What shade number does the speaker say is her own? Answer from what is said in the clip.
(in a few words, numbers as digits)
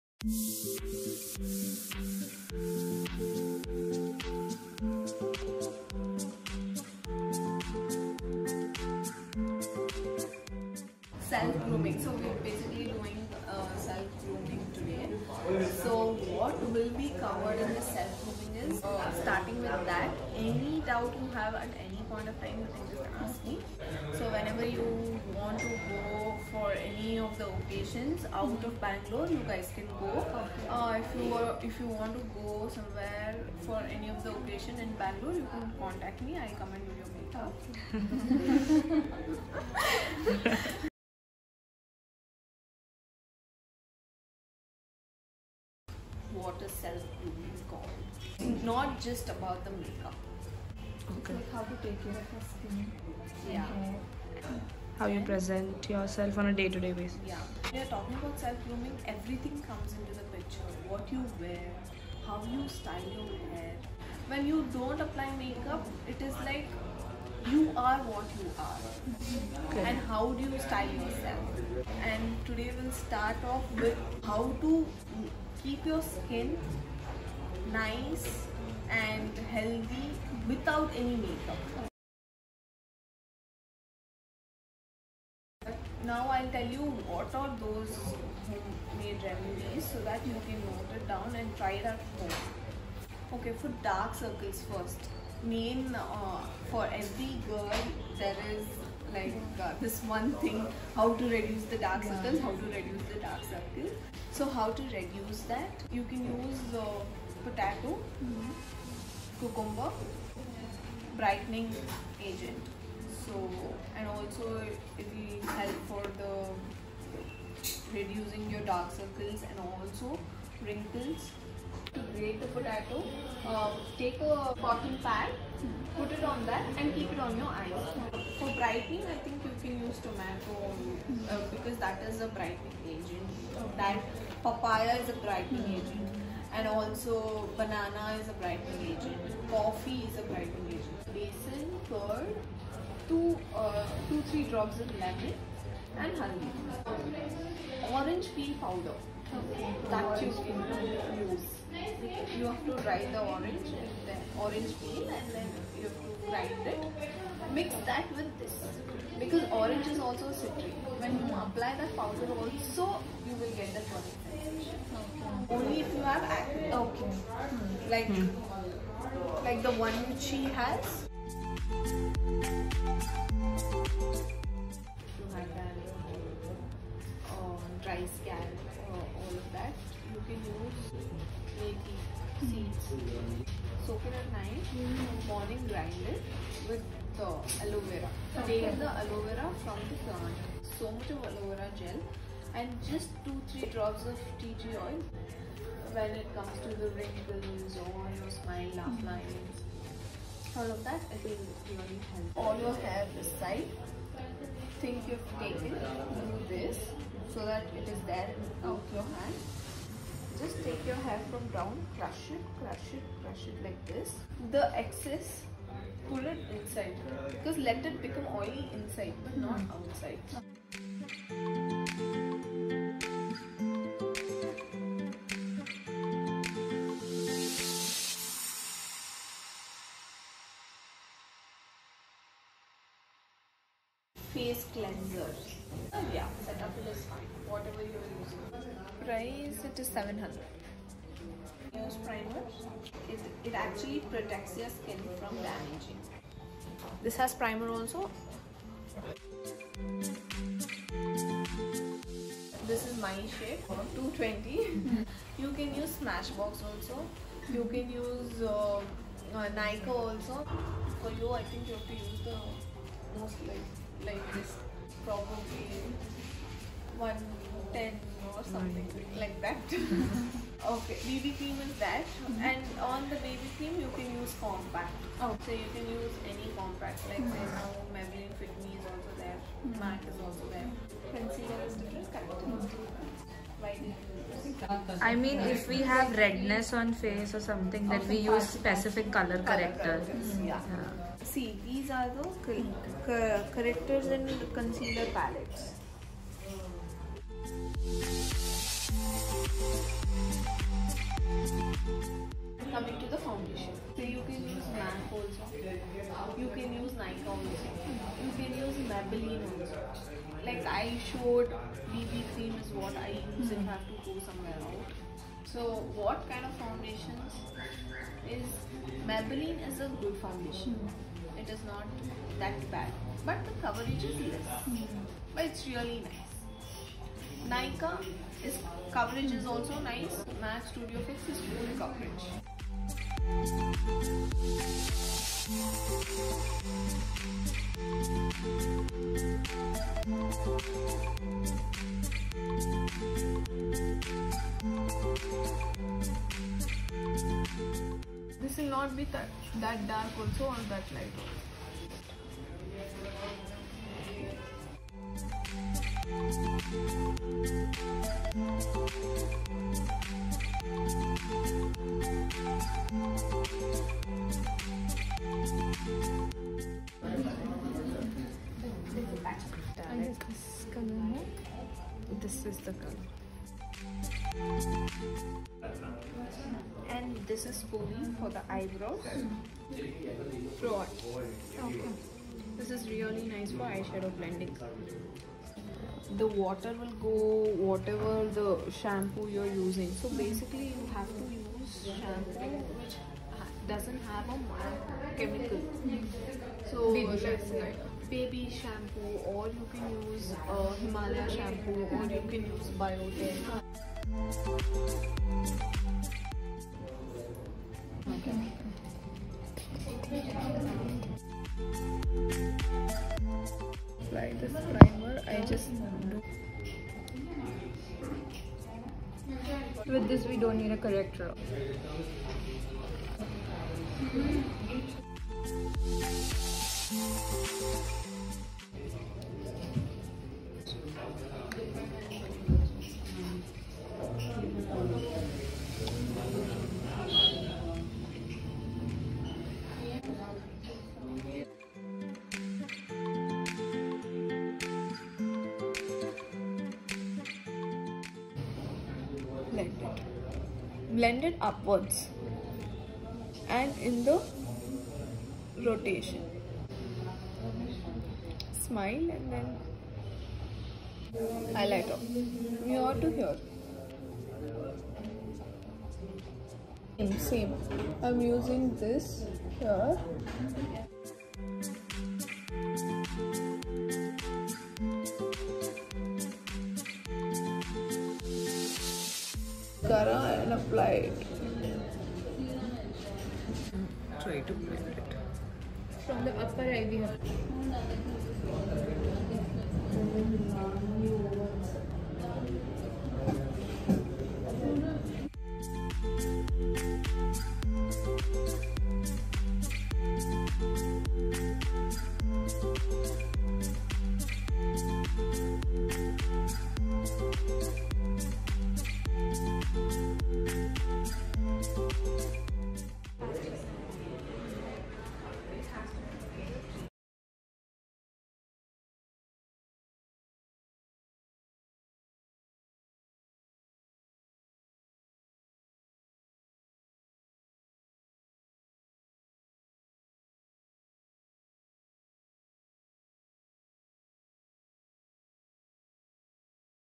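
220.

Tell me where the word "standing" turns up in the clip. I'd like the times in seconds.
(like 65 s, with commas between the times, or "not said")
not said.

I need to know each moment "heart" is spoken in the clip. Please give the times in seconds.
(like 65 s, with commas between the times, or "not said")
not said.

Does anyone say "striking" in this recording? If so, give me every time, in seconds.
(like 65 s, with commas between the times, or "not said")
not said.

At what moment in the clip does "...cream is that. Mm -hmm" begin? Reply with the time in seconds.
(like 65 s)
271 s.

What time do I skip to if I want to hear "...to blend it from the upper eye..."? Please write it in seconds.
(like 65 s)
484 s.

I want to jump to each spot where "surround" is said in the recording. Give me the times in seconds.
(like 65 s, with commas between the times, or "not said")
not said.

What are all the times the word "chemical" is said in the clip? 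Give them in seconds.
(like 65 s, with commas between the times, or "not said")
395 s.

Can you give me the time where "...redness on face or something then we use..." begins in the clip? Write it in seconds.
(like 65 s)
286 s.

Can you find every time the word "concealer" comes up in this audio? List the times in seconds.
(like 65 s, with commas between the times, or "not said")
281 s, 294 s.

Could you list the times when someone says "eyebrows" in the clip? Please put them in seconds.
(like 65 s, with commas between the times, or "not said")
378 s.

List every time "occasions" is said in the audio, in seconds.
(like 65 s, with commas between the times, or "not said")
27 s, 34 s.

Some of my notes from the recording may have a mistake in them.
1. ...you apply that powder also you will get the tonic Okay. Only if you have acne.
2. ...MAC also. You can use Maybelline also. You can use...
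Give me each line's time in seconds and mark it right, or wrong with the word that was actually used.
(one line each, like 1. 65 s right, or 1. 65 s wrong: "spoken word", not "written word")
1. 161 s right
2. 304 s wrong: "Nykaa", not "Maybelline".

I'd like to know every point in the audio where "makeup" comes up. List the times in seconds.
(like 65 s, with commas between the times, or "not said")
37 s, 49 s, 65 s, 81 s.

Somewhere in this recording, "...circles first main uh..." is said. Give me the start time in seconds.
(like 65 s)
94 s.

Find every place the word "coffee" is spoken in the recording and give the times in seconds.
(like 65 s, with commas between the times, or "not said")
139 s.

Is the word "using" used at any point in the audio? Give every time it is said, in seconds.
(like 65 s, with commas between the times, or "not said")
238 s, 389 s, 468 s.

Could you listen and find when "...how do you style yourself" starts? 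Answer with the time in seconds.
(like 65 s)
70 s.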